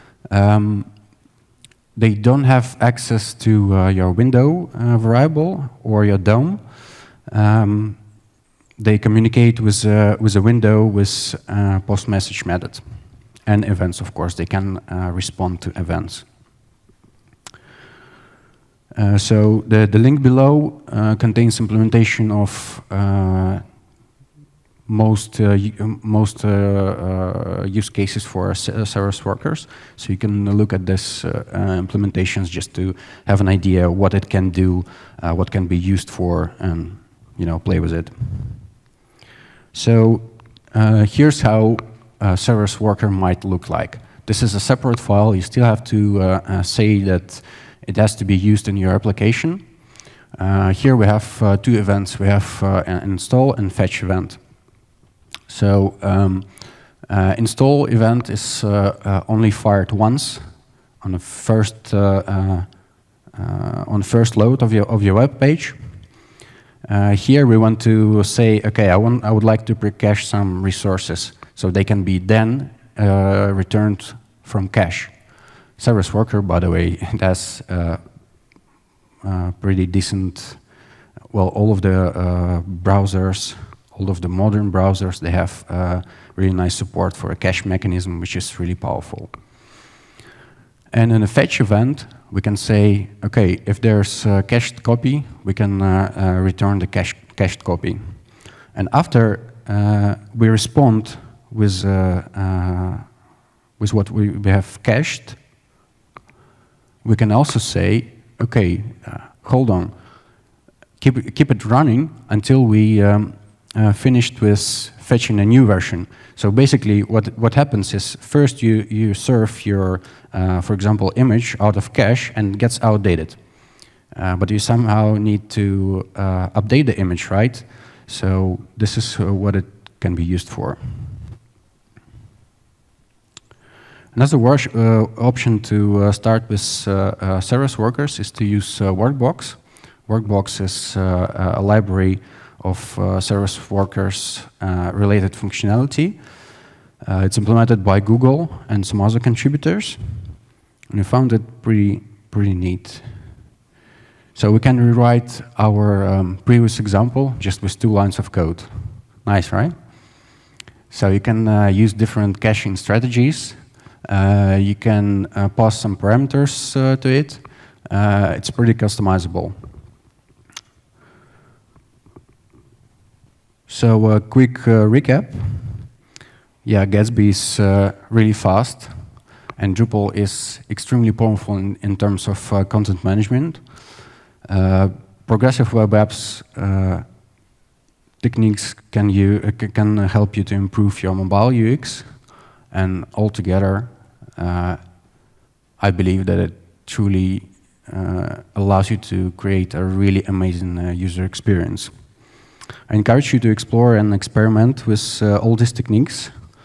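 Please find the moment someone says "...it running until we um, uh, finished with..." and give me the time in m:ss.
1:51.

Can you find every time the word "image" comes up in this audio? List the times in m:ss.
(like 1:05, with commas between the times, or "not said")
2:01, 2:06.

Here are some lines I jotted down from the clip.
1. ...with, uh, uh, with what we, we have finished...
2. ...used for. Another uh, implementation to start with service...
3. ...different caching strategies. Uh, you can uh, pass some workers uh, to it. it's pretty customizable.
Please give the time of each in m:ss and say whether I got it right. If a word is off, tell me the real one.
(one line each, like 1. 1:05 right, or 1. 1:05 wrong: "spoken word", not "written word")
1. 1:41 wrong: "cached", not "finished"
2. 2:10 wrong: "option", not "implementation"
3. 2:41 wrong: "parameters", not "workers".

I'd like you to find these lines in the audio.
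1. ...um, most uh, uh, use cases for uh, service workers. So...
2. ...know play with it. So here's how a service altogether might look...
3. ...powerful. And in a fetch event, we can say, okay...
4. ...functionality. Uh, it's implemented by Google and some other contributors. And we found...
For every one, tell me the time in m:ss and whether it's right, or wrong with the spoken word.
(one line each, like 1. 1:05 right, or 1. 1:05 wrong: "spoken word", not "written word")
1. 0:25 right
2. 0:37 wrong: "worker", not "altogether"
3. 1:28 right
4. 2:25 right.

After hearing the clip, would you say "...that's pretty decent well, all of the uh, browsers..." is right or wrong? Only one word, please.
right.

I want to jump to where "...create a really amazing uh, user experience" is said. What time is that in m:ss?
3:19.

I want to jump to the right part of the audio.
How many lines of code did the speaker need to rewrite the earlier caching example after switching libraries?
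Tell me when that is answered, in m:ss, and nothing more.
2:37.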